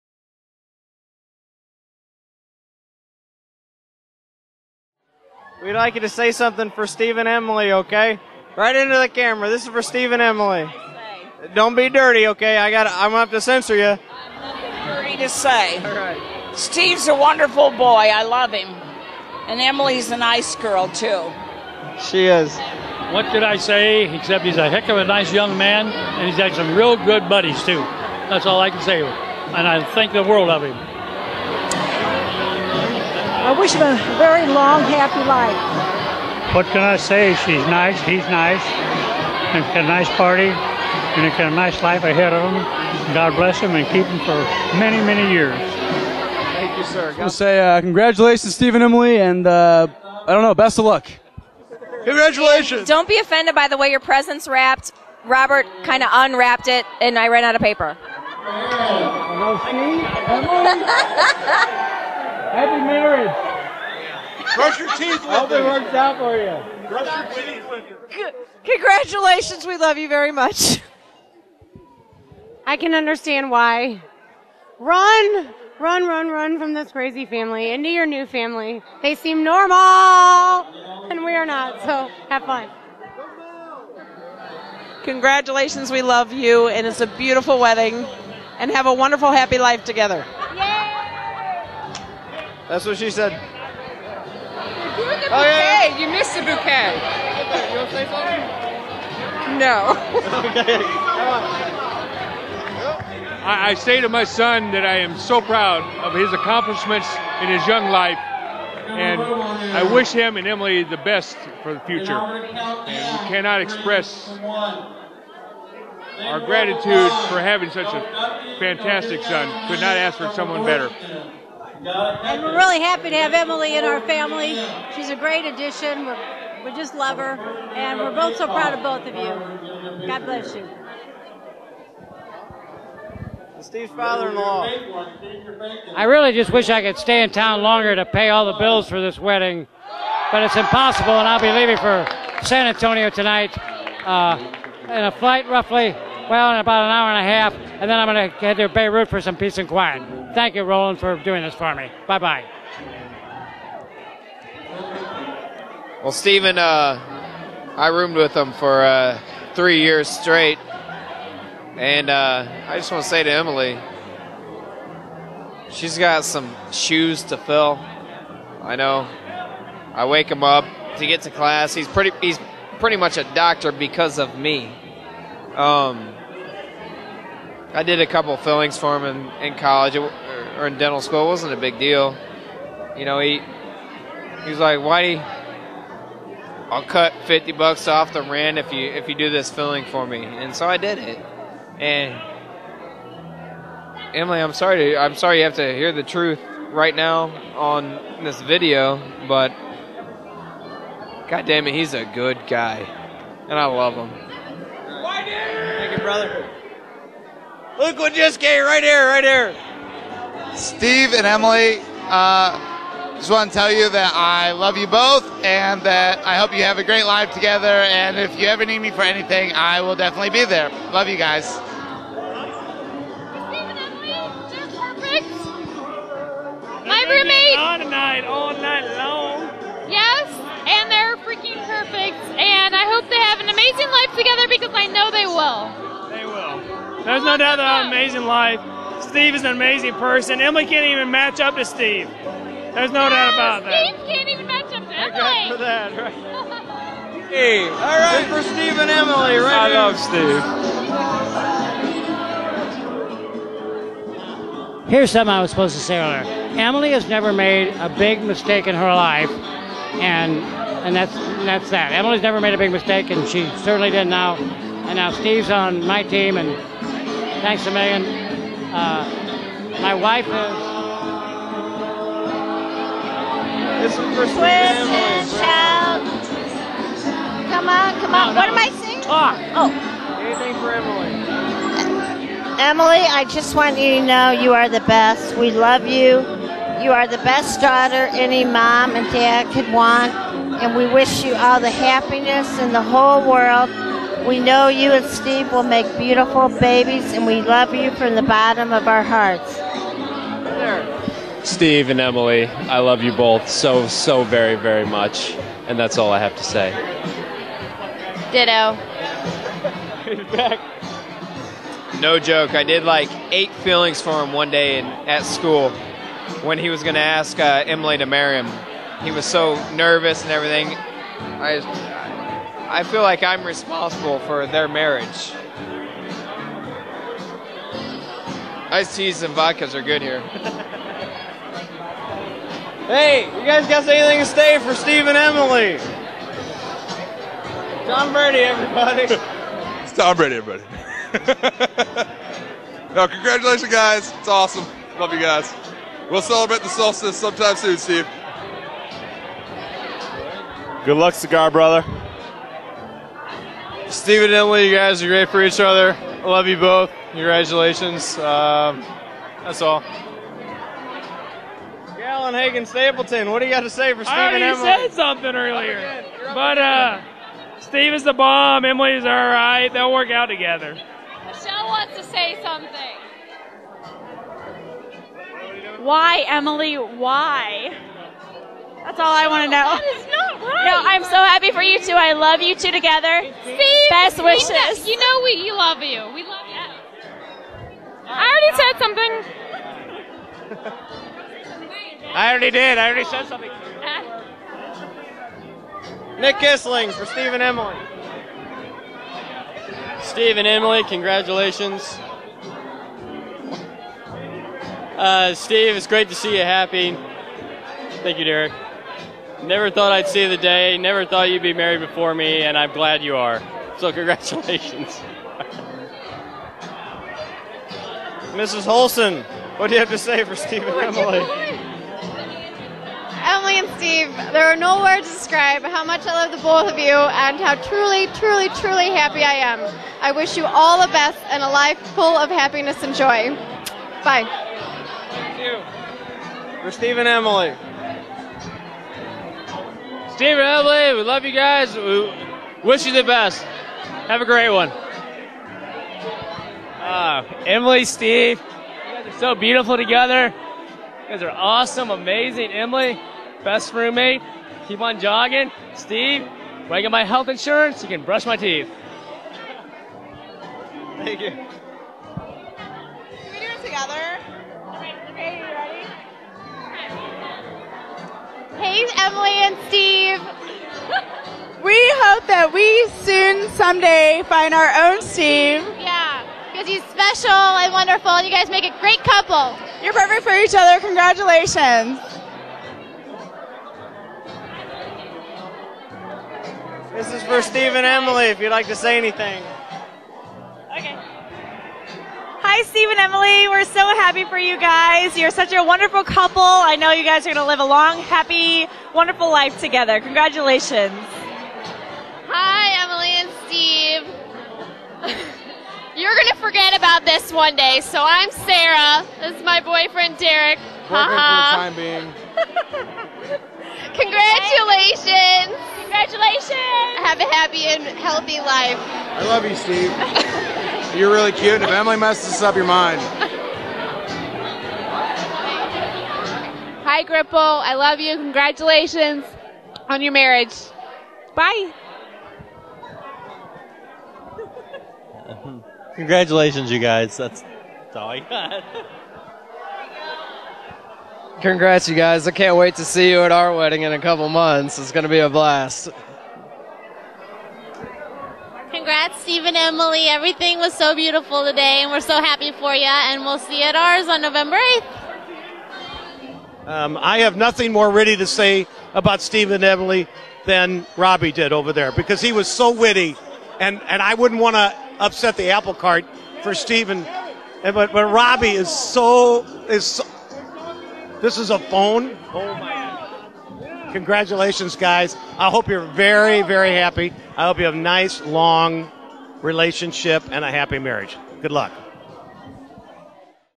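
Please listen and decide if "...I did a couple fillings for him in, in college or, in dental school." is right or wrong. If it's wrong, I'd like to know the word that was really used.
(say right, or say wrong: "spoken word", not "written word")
right.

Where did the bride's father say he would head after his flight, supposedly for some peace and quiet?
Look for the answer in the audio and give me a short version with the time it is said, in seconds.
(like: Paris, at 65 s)
Beirut, at 148 s.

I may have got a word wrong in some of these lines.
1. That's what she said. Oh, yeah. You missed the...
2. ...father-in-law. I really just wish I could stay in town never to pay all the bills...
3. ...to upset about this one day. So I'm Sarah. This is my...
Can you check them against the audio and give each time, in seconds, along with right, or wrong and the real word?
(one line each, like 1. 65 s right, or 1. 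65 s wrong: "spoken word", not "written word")
1. 92 s right
2. 133 s wrong: "longer", not "never"
3. 506 s wrong: "forget", not "upset".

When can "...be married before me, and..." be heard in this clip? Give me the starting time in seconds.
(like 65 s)
411 s.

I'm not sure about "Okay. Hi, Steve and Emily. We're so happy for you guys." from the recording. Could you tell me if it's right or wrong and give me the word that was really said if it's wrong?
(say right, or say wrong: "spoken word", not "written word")
right.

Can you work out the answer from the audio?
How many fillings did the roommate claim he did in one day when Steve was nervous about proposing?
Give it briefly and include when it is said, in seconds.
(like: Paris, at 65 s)
8, at 313 s.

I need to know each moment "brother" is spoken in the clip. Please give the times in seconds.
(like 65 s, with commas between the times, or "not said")
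205 s, 351 s.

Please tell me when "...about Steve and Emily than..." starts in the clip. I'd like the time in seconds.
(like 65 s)
558 s.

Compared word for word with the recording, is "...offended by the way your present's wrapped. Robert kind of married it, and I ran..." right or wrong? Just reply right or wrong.
wrong.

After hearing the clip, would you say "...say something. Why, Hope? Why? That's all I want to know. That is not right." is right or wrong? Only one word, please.
wrong.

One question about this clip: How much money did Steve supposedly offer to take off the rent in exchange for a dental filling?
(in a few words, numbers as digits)
$50.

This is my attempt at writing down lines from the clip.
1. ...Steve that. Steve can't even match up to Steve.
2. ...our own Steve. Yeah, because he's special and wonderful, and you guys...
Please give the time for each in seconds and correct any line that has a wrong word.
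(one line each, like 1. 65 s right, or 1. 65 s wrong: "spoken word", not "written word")
1. 243 s wrong: "Emily", not "Steve"
2. 474 s right.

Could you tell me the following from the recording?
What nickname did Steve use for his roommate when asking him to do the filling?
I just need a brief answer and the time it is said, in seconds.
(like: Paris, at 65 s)
Whitey, at 184 s.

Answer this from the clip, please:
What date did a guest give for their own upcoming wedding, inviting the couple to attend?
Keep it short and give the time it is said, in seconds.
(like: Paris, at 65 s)
November 8th, at 554 s.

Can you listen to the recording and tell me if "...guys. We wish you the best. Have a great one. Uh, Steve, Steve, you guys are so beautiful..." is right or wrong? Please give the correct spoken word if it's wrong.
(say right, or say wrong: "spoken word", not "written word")
wrong: "Emily", not "Steve".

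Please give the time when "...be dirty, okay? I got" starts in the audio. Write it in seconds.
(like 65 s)
11 s.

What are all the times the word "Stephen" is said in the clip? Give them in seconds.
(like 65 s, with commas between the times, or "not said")
48 s, 156 s.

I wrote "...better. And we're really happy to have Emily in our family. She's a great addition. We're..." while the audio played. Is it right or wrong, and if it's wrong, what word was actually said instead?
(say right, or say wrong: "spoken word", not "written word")
right.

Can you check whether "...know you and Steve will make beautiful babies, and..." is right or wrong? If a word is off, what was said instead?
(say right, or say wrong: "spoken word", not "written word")
right.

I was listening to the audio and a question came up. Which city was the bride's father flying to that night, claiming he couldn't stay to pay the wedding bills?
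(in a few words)
San Antonio.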